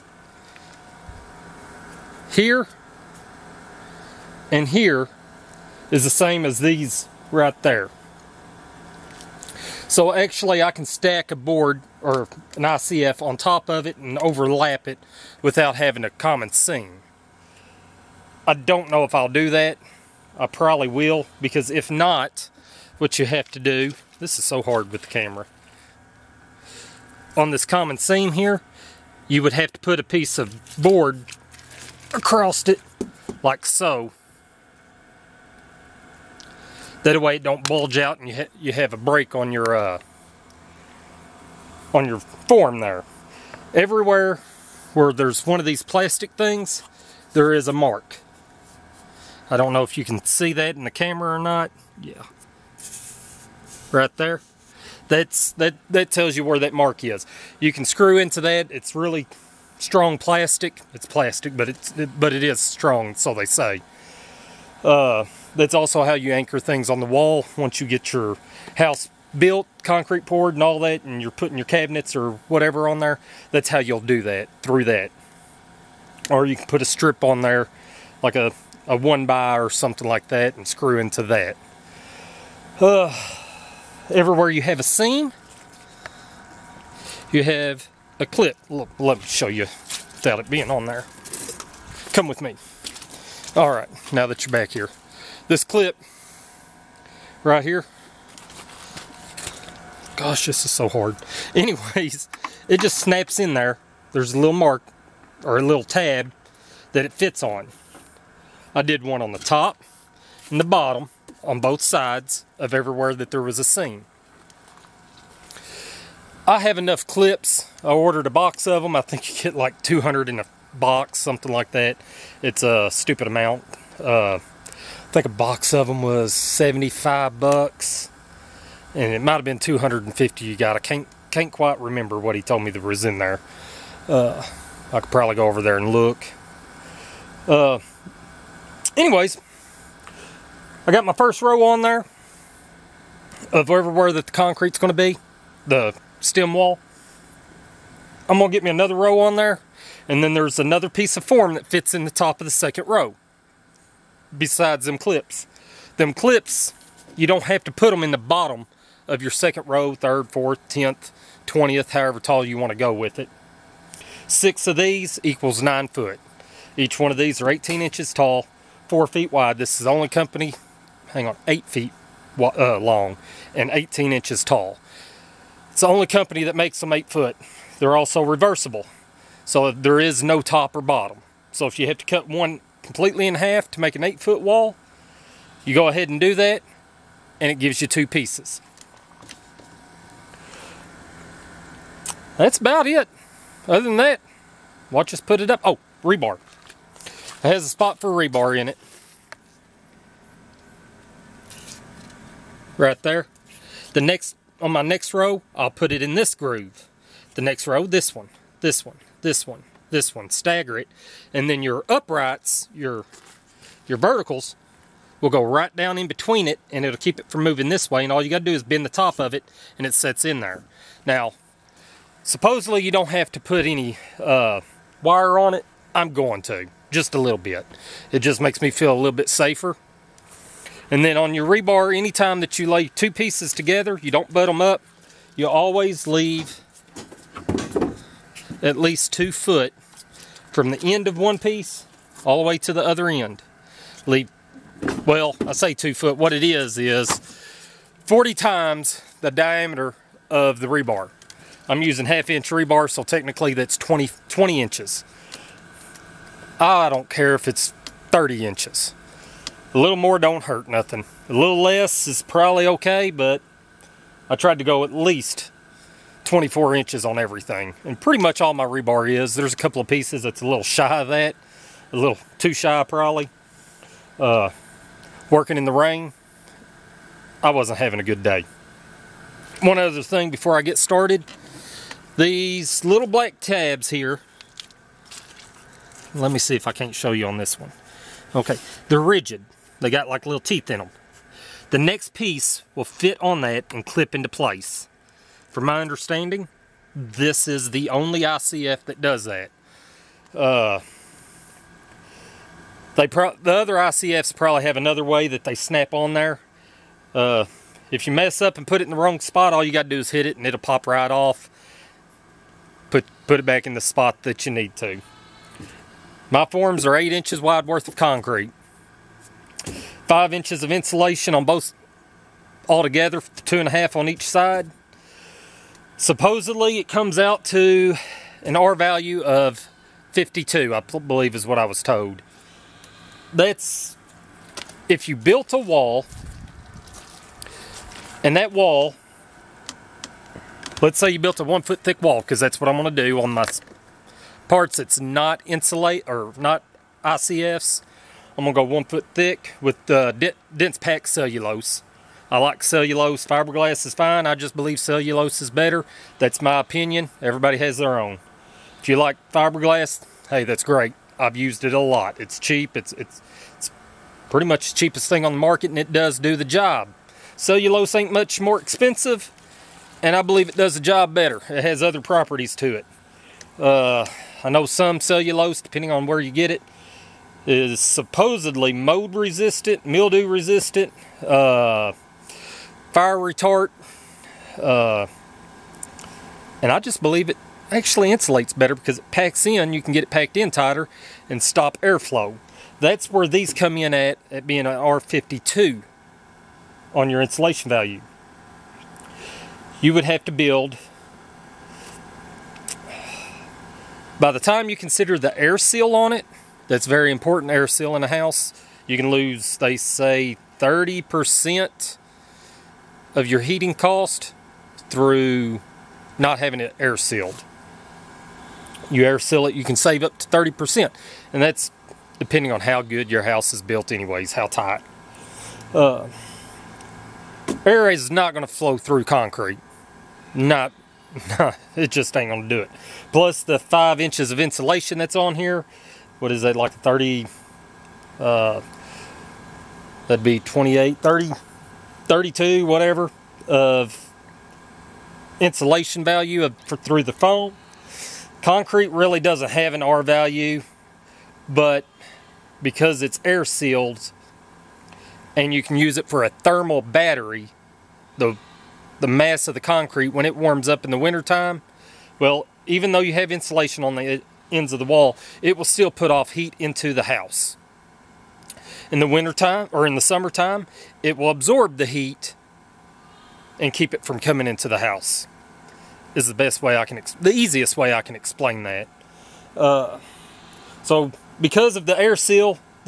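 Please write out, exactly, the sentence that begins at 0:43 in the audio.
Everywhere where there's one of these plastic things, there is a mark.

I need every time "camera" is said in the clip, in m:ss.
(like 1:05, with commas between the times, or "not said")
0:25, 0:50.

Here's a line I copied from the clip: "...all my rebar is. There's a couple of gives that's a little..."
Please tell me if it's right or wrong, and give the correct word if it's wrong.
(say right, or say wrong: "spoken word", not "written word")
wrong: "pieces", not "gives".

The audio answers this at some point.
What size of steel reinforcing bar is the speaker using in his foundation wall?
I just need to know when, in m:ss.
4:12.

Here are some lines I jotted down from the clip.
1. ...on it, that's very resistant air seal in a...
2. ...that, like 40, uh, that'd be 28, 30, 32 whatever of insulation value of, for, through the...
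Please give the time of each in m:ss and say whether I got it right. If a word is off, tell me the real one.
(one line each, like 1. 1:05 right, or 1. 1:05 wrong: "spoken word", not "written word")
1. 6:45 wrong: "important", not "resistant"
2. 7:16 wrong: "30", not "40".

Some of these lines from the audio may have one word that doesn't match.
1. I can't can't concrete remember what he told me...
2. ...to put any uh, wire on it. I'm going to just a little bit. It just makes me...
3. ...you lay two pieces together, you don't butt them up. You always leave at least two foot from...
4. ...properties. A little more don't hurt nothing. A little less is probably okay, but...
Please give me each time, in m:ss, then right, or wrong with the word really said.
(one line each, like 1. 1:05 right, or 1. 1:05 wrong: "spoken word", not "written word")
1. 2:10 wrong: "quite", not "concrete"
2. 3:43 right
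3. 3:52 right
4. 4:18 wrong: "inches", not "properties".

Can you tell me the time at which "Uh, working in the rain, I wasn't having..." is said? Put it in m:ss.
4:34.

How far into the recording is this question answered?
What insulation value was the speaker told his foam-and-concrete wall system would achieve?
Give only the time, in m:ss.
5:28.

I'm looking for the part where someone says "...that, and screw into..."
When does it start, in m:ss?
1:20.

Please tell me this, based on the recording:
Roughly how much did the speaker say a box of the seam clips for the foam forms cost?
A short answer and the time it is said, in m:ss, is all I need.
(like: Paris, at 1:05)
$75, at 2:06.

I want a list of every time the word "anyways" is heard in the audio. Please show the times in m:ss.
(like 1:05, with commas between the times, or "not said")
1:41, 2:18, 7:03.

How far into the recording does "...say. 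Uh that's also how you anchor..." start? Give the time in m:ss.
1:03.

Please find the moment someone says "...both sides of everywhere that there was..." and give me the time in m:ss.
1:51.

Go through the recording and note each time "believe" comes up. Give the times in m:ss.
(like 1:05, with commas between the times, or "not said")
5:30, 5:54, 6:10, 6:26.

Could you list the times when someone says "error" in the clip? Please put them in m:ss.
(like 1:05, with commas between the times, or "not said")
not said.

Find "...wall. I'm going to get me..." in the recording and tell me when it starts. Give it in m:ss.
2:26.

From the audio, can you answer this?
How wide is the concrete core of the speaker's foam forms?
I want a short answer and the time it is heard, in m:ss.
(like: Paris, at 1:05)
8 inches, at 5:16.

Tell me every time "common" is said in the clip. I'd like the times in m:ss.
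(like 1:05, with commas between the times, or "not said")
0:16, 0:27.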